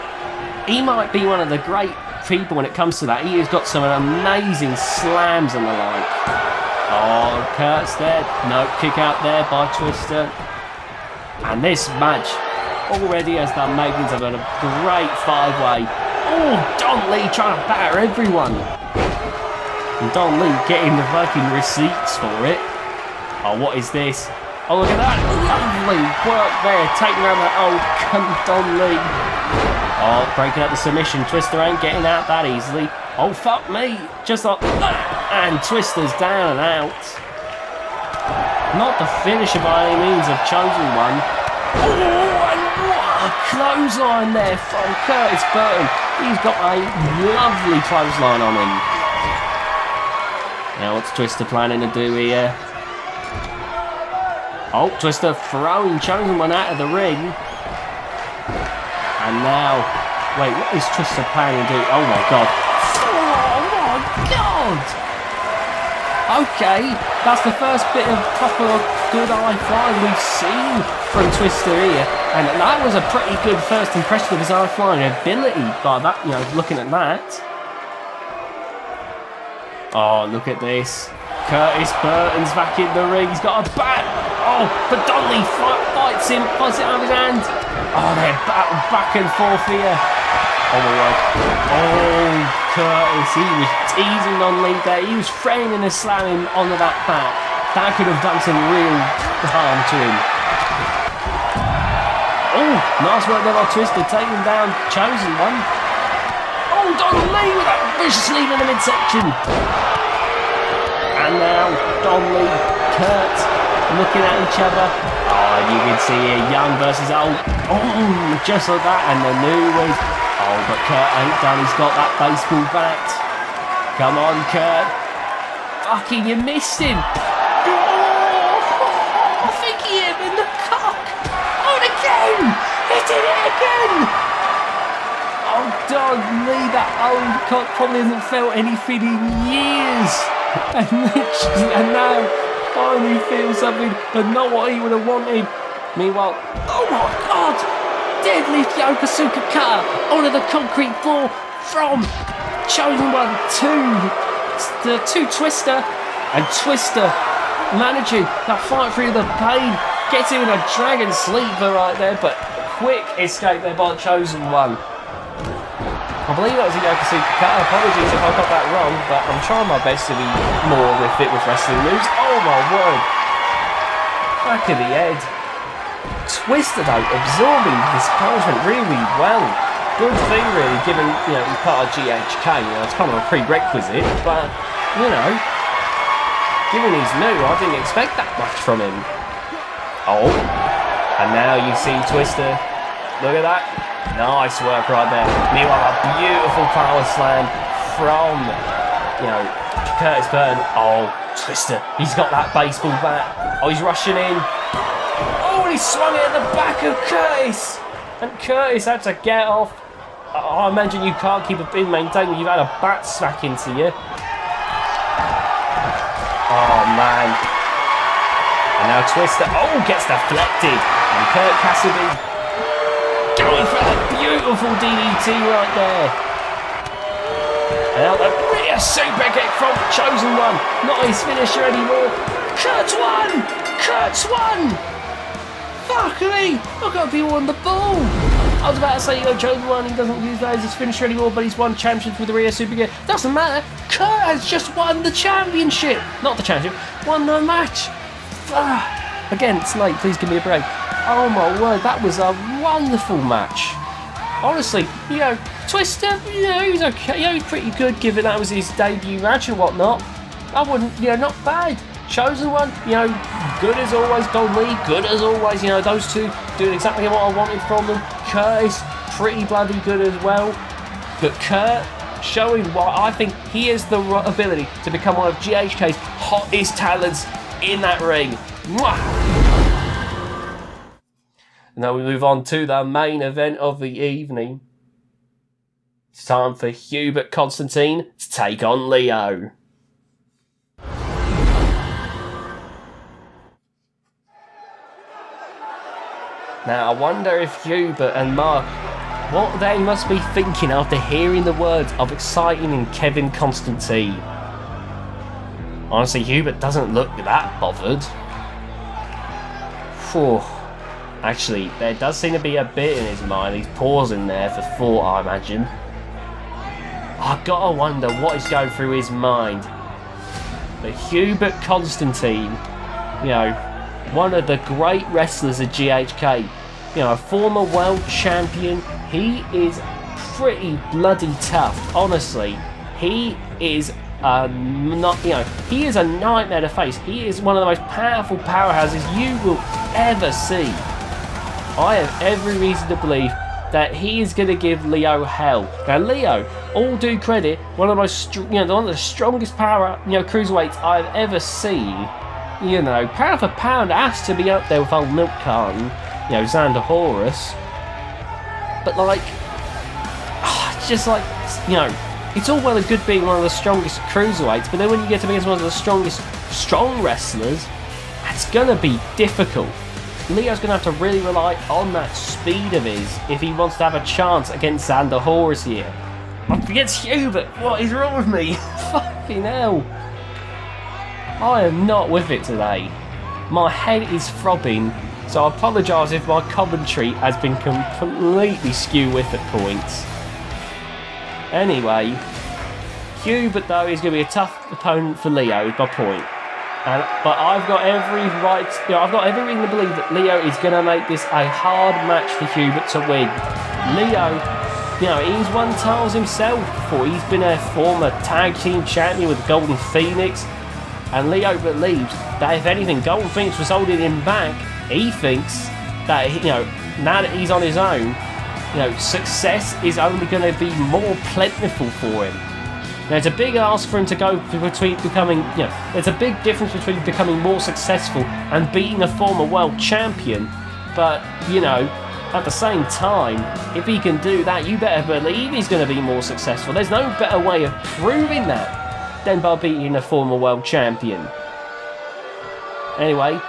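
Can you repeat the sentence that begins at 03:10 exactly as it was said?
Oh, and now you see Twister, look at that, nice work right there.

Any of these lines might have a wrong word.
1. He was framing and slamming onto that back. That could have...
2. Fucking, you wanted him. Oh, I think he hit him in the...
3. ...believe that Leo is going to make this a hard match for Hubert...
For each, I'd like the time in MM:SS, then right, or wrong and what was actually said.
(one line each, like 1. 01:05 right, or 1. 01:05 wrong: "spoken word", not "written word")
1. 01:35 right
2. 02:05 wrong: "missed", not "wanted"
3. 06:39 right.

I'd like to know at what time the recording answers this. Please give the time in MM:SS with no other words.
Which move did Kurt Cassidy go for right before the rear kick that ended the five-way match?
03:44.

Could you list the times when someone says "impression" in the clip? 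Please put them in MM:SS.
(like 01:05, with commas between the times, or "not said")
01:13.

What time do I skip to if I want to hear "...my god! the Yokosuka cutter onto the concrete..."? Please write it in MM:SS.
02:26.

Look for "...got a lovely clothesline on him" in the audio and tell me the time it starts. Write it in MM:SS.
00:46.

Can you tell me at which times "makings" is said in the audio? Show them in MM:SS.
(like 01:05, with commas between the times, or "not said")
00:13.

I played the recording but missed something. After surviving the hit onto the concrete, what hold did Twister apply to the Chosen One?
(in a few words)
Dragon sleeper.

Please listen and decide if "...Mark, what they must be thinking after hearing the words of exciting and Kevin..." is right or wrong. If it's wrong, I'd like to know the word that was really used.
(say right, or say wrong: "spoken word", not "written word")
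right.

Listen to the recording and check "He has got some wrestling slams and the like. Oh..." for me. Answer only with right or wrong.
wrong.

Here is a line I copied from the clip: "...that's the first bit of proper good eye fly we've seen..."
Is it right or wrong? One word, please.
right.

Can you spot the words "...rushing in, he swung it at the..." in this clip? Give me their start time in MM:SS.
03:23.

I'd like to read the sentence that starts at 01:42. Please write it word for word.
Oh, nice work there by Twister, taking down Chosen One.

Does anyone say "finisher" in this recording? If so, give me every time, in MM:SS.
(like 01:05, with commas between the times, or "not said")
00:39, 03:51, 04:00.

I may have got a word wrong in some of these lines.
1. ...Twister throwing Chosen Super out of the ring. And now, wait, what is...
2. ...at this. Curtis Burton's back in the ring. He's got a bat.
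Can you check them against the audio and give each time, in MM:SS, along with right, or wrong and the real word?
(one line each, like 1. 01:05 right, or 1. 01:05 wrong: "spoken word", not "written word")
1. 00:54 wrong: "One", not "Super"
2. 01:20 right.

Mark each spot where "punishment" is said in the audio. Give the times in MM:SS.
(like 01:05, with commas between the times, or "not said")
02:58.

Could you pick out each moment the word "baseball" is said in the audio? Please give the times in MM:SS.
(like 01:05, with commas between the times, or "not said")
02:02, 03:22.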